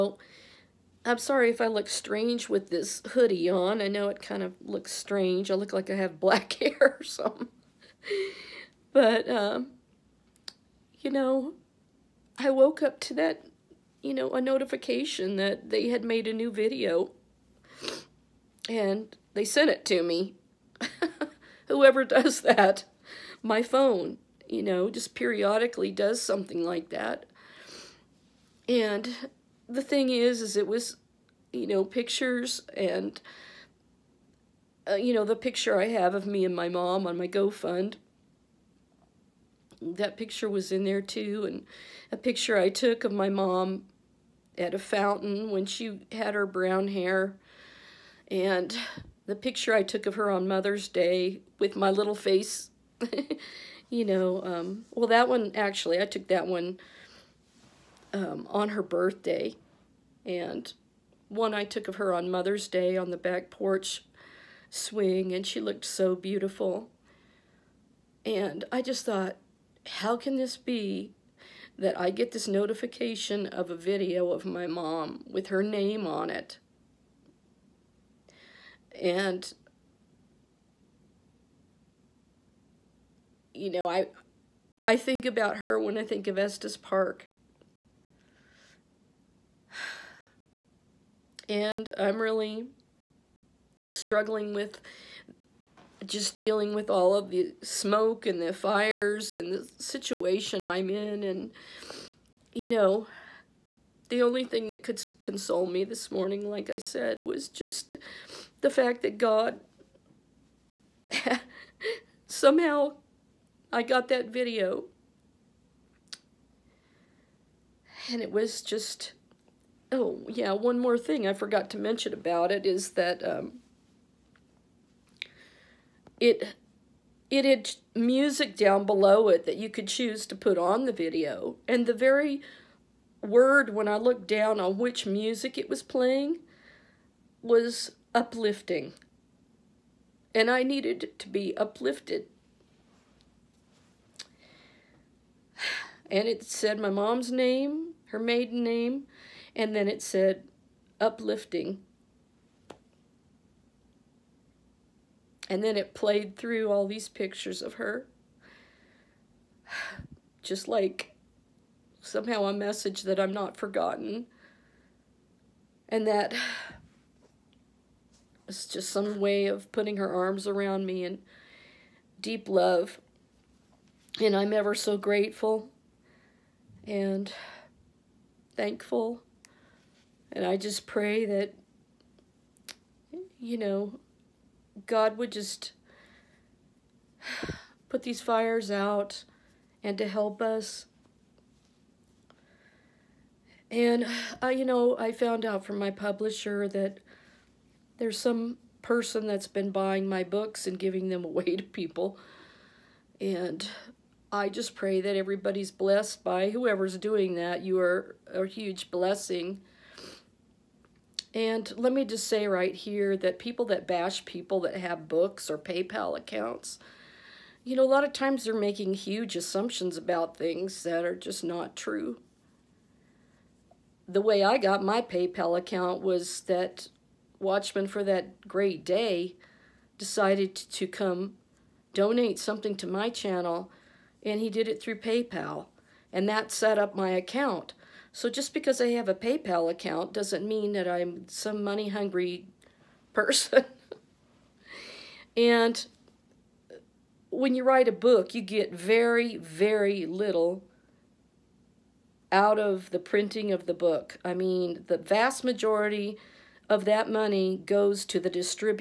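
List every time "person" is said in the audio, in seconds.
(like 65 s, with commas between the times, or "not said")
198 s, 243 s.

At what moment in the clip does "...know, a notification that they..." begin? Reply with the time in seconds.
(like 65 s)
14 s.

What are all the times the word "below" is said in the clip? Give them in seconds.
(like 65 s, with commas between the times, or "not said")
128 s.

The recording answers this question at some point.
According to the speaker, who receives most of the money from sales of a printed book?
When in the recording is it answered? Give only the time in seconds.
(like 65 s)
258 s.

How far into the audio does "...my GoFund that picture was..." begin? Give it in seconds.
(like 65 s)
37 s.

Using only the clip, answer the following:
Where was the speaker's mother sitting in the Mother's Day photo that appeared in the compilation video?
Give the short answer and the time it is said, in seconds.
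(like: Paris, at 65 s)
back porch swing, at 63 s.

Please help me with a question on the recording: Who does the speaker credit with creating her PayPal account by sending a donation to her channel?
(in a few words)
Watchman for that great day.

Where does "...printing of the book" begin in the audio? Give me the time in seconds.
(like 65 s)
252 s.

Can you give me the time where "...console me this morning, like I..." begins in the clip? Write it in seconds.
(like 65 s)
105 s.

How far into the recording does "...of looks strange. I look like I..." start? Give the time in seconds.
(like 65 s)
4 s.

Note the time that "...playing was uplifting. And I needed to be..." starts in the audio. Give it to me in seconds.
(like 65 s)
135 s.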